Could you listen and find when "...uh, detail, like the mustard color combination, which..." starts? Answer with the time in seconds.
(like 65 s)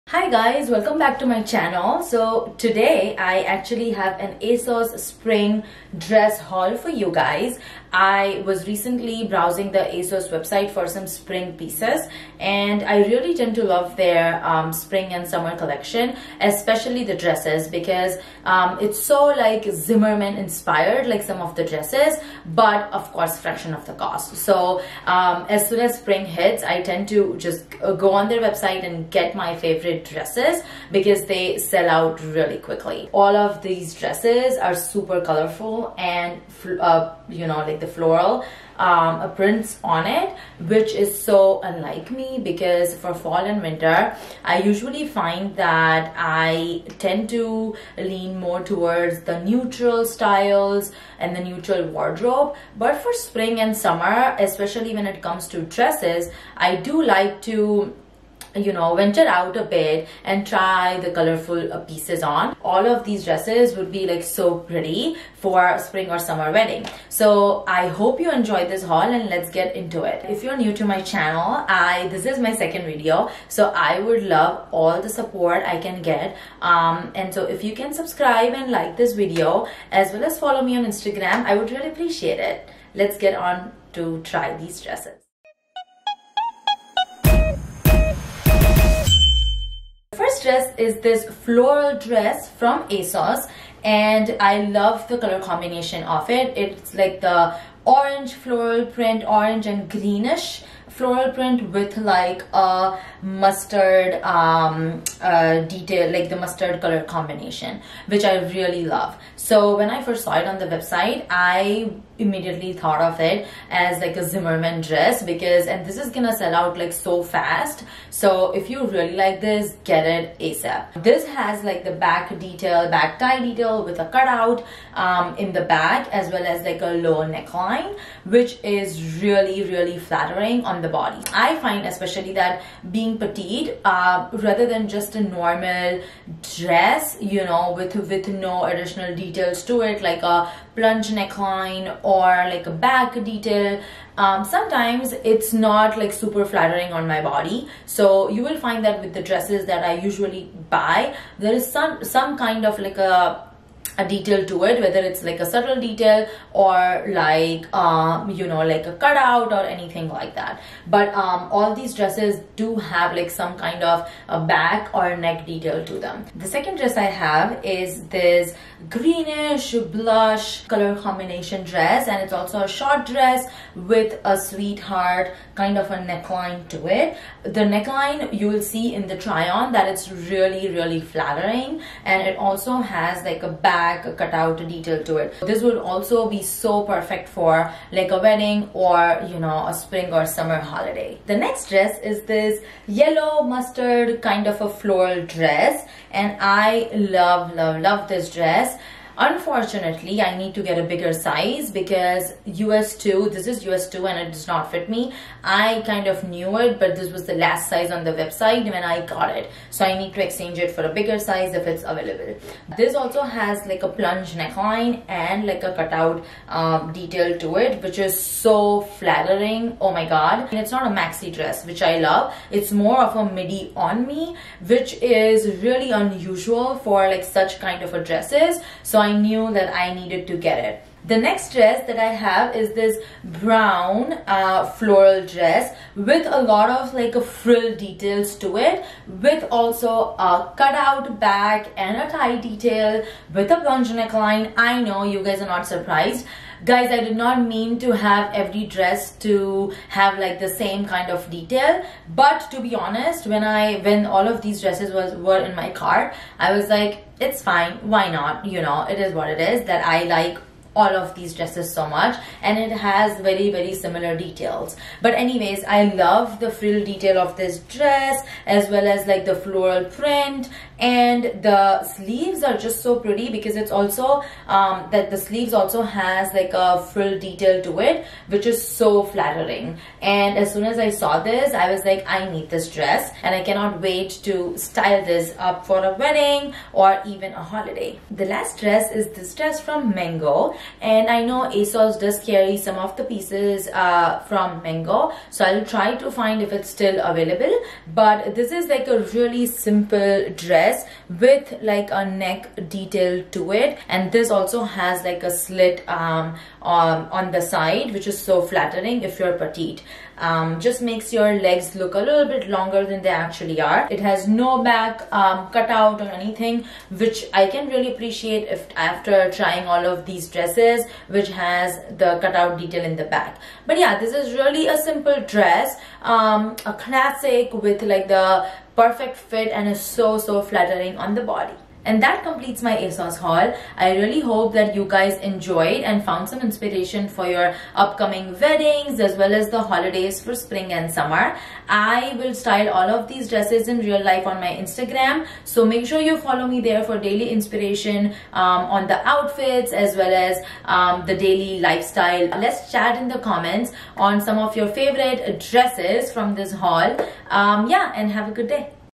105 s.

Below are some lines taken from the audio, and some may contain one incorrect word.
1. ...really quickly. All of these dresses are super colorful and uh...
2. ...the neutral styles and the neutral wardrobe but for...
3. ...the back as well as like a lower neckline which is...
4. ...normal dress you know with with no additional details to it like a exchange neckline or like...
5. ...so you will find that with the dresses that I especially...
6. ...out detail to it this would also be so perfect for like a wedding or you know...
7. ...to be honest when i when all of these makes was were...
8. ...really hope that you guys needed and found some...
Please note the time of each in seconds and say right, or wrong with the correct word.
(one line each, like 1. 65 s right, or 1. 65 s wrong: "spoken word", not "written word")
1. 32 s right
2. 49 s right
3. 125 s right
4. 135 s wrong: "plunge", not "exchange"
5. 147 s wrong: "usually", not "especially"
6. 184 s right
7. 252 s wrong: "dresses", not "makes"
8. 333 s wrong: "enjoyed", not "needed".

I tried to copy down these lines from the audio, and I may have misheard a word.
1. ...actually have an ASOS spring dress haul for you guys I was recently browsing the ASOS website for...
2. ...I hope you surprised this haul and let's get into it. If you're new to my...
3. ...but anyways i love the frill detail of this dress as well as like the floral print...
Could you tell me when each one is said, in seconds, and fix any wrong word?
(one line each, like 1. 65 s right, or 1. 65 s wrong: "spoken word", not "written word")
1. 3 s right
2. 67 s wrong: "enjoyed", not "surprised"
3. 265 s right.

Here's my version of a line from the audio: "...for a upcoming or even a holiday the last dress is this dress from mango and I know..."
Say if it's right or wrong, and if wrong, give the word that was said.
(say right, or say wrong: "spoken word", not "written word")
wrong: "wedding", not "upcoming".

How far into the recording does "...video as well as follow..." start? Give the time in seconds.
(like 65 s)
79 s.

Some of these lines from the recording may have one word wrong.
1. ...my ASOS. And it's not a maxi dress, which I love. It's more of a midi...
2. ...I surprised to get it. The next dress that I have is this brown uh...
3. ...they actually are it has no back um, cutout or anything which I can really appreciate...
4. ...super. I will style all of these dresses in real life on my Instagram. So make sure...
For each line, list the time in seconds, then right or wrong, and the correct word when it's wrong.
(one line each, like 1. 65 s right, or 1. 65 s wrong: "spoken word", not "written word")
1. 219 s wrong: "God", not "ASOS"
2. 229 s wrong: "needed", not "surprised"
3. 313 s right
4. 340 s wrong: "summer", not "super".